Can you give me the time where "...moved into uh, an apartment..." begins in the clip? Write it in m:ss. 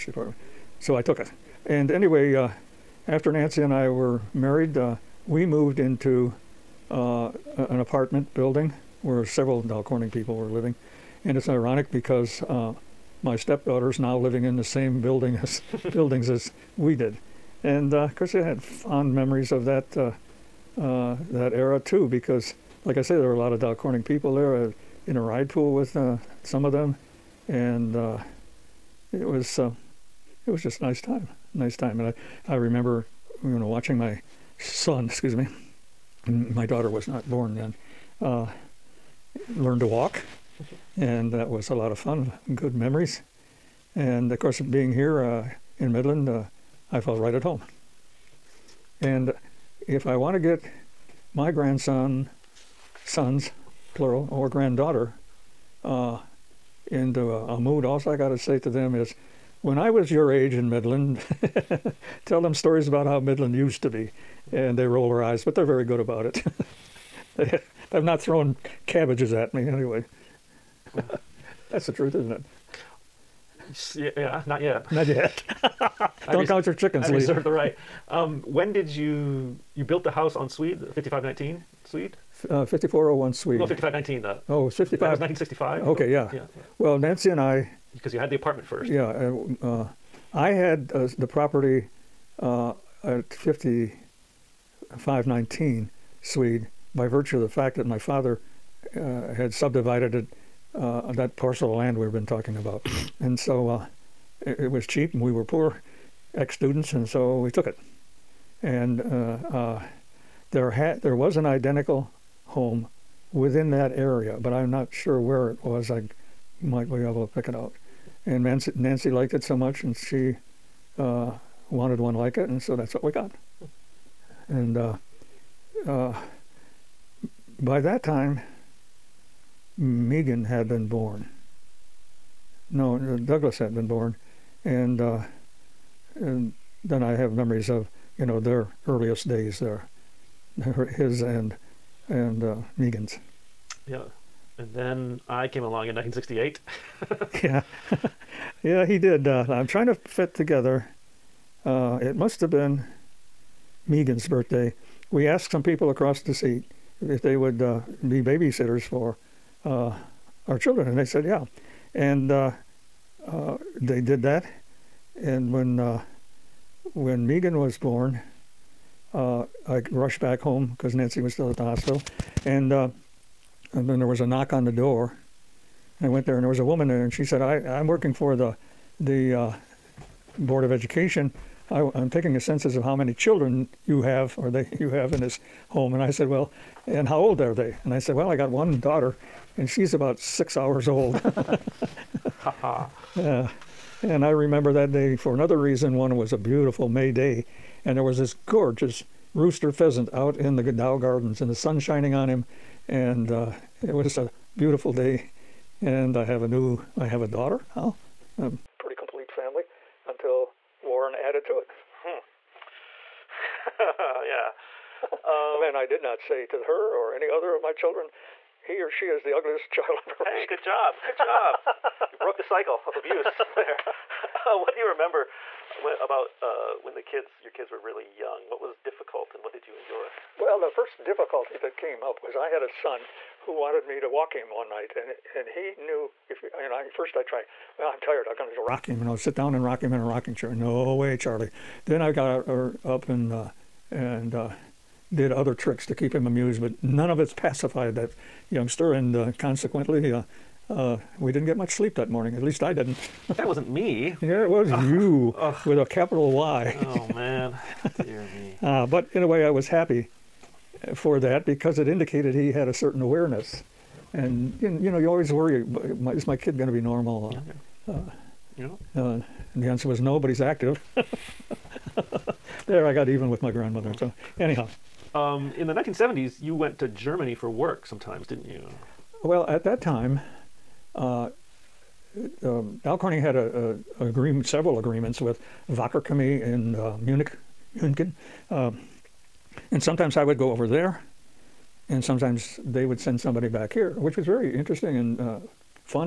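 0:05.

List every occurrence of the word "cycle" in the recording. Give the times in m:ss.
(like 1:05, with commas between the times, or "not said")
3:42.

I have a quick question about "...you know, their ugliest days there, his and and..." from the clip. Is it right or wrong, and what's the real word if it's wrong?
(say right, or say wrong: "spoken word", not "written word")
wrong: "earliest", not "ugliest".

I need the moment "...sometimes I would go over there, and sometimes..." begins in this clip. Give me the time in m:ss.
4:49.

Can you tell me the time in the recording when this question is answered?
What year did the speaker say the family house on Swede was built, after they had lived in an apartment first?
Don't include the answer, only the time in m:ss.
1:25.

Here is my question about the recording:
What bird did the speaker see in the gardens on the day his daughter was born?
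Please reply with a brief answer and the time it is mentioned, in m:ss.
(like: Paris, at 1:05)
rooster pheasant, at 3:19.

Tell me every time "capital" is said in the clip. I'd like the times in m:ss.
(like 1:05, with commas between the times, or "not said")
4:15.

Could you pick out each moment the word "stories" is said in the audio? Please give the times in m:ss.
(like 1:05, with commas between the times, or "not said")
1:02.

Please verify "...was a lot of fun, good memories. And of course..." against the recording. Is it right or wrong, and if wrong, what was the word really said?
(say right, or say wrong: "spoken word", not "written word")
right.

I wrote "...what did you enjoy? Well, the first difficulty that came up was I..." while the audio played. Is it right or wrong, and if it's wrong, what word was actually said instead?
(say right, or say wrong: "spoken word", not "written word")
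right.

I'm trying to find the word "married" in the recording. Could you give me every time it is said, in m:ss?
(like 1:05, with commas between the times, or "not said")
0:04.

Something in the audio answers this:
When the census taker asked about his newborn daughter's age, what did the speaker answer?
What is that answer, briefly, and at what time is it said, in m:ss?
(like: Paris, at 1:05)
6 hours old, at 3:10.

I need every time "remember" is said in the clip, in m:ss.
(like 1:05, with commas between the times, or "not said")
0:32, 3:14, 3:44.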